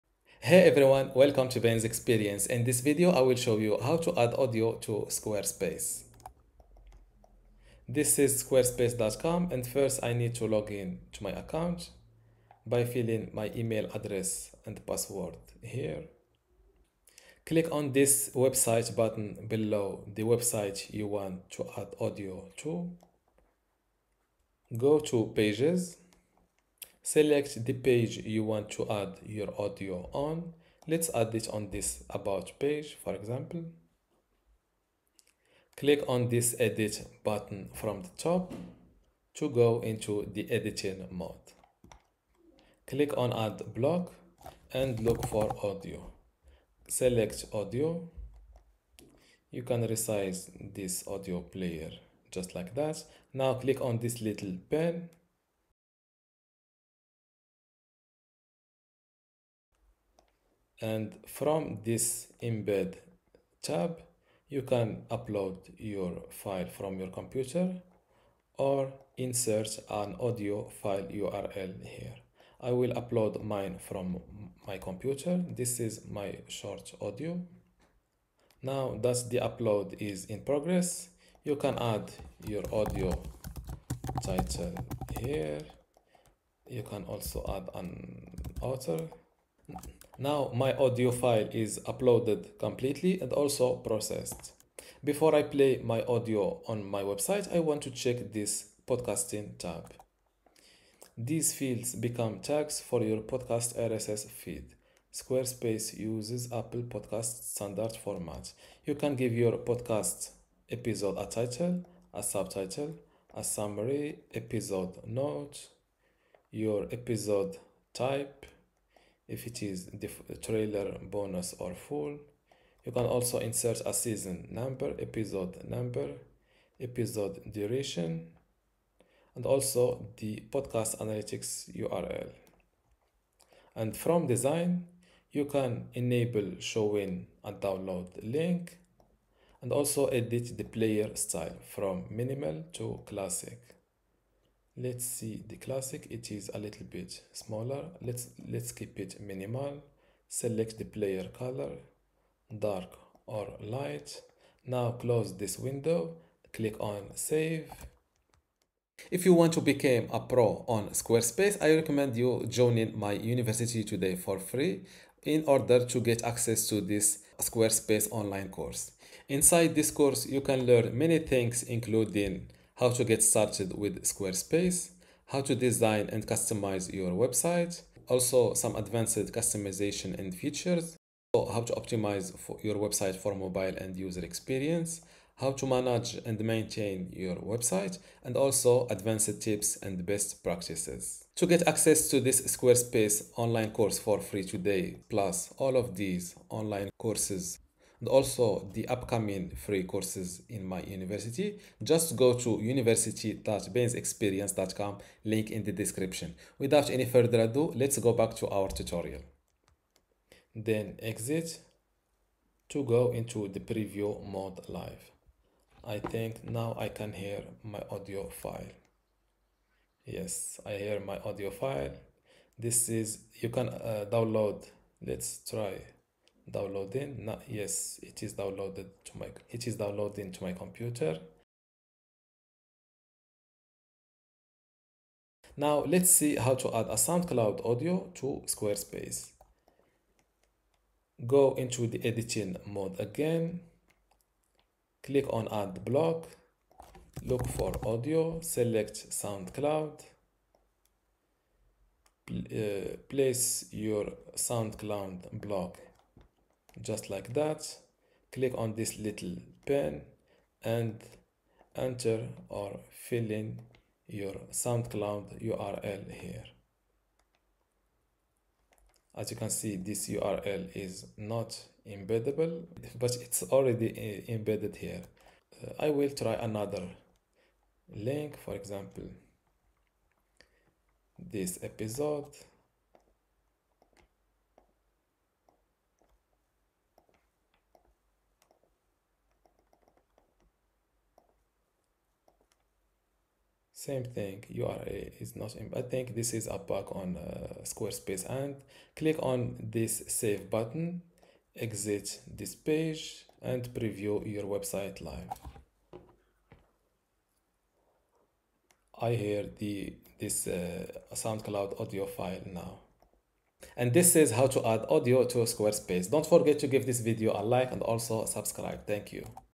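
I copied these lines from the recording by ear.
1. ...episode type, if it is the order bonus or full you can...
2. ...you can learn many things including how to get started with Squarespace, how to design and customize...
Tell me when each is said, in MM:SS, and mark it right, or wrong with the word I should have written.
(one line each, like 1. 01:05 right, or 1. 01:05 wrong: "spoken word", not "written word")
1. 01:56 wrong: "trailer", not "order"
2. 02:50 right.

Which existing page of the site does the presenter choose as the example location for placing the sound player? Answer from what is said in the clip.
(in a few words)
About page.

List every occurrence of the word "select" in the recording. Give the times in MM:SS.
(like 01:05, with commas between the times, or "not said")
00:27, 00:46, 02:30, 04:08.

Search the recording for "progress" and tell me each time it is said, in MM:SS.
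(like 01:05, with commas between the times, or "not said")
01:20.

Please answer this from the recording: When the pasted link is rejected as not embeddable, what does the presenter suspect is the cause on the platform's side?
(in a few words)
A bug.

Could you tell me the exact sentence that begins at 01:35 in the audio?
Before I play my audio on my website, I want to check this podcasting tab.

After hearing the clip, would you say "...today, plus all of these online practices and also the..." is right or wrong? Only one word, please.
wrong.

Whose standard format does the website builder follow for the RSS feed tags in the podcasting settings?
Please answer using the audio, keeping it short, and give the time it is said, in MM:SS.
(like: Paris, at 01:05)
Apple Podcast, at 01:46.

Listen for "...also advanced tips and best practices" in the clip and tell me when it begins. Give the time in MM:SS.
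03:08.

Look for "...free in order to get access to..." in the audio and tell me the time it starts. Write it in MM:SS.
02:44.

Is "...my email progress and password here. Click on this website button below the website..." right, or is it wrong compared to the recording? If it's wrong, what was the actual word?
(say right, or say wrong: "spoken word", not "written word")
wrong: "address", not "progress".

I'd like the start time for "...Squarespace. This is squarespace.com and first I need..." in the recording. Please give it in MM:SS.
00:05.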